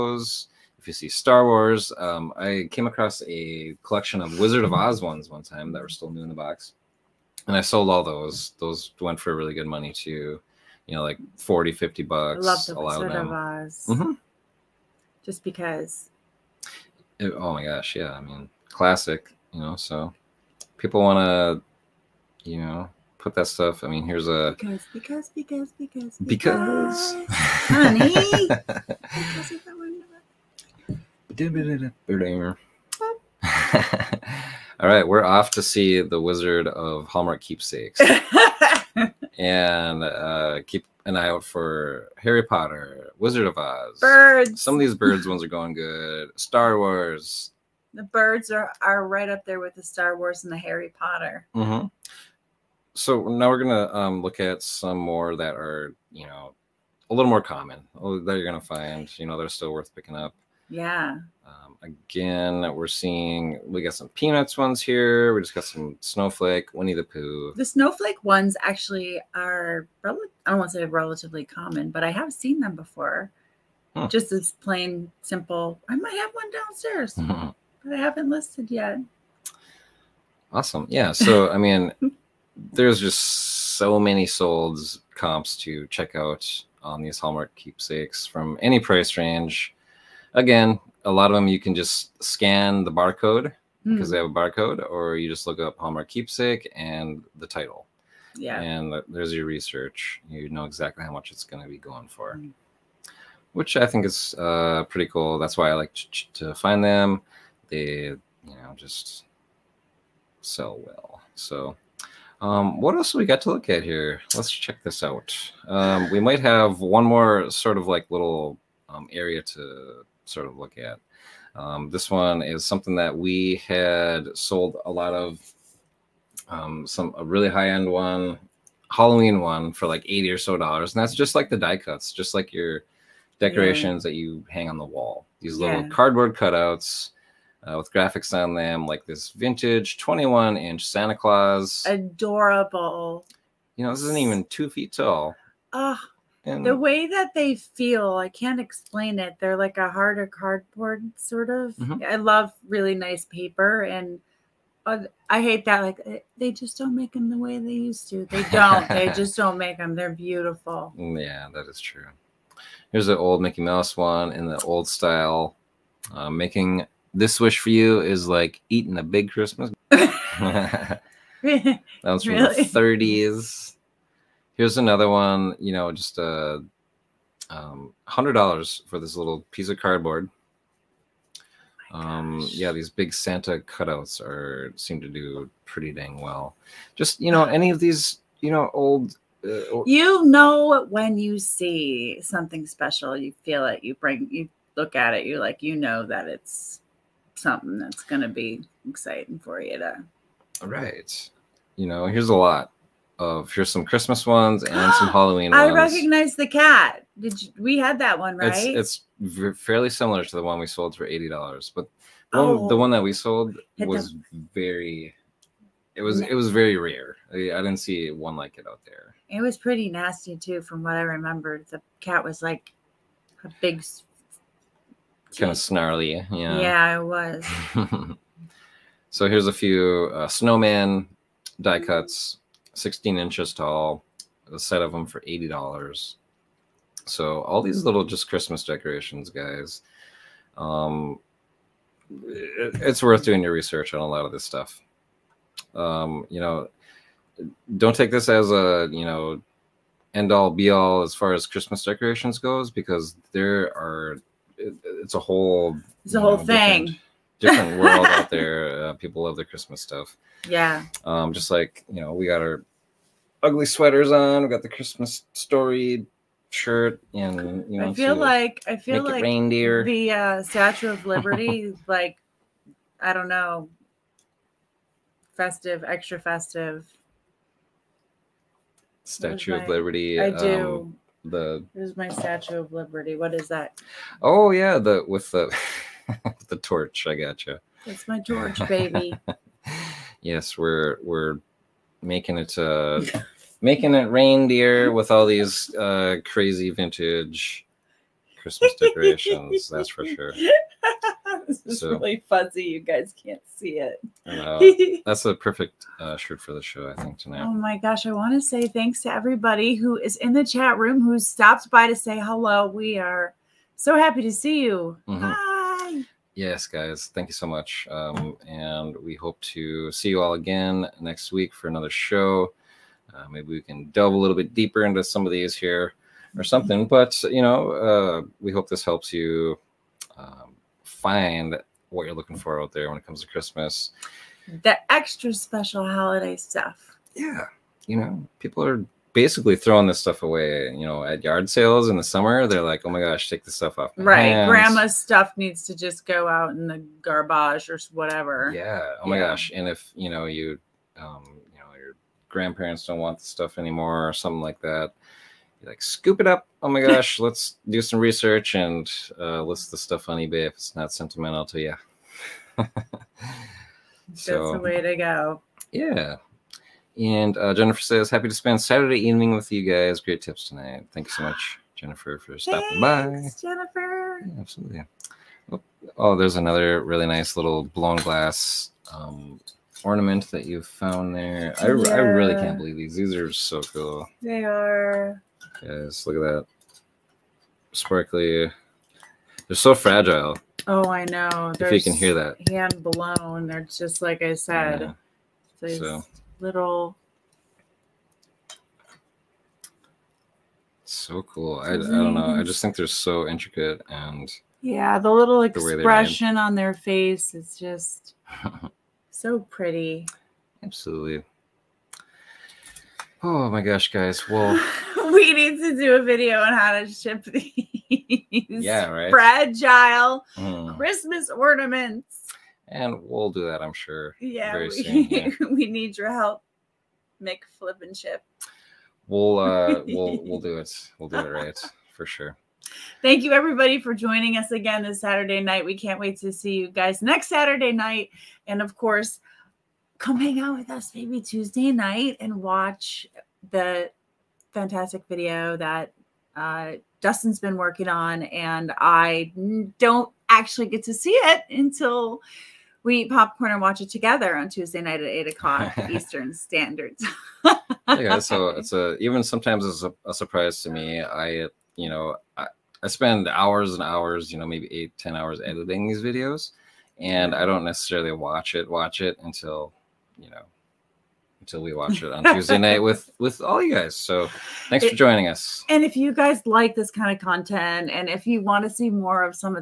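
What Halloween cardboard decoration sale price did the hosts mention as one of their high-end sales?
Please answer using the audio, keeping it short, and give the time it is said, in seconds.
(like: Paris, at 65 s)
$80, at 130 s.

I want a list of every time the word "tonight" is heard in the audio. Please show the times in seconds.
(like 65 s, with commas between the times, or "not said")
307 s, 370 s.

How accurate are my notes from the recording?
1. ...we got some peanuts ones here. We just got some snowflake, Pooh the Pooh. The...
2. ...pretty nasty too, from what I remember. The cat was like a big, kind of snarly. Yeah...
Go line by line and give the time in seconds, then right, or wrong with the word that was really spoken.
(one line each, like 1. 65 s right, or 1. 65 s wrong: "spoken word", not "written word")
1. 63 s wrong: "Winnie", not "Pooh"
2. 219 s right.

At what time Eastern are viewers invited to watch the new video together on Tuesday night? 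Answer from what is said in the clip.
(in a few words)
8:00.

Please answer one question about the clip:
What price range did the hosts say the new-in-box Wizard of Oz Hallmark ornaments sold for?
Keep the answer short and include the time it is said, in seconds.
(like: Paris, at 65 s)
40, 50 bucks, at 11 s.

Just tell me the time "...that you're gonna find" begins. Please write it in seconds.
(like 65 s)
58 s.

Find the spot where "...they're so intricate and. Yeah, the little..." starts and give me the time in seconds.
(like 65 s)
402 s.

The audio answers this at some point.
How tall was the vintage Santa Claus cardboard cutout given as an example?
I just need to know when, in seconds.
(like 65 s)
139 s.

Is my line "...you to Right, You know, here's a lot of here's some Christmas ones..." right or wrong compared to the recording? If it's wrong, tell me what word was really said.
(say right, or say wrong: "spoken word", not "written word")
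right.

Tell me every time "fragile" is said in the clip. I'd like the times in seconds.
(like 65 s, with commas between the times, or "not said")
389 s, 419 s.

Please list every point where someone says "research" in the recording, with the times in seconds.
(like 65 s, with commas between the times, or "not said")
99 s, 243 s, 357 s.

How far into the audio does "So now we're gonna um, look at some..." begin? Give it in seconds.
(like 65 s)
52 s.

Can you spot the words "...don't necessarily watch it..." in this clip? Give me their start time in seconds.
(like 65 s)
467 s.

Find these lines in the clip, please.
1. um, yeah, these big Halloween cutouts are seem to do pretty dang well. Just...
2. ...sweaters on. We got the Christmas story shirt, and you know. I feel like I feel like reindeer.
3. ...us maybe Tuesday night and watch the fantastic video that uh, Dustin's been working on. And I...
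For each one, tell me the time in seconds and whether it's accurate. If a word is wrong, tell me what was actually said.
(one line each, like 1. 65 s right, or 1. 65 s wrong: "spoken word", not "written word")
1. 181 s wrong: "Santa", not "Halloween"
2. 263 s right
3. 440 s right.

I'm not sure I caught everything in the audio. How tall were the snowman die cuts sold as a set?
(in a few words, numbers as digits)
16 inches.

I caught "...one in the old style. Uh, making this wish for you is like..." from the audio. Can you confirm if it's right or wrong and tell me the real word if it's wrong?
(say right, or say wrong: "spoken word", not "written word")
right.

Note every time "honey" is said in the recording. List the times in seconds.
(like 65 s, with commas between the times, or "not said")
27 s.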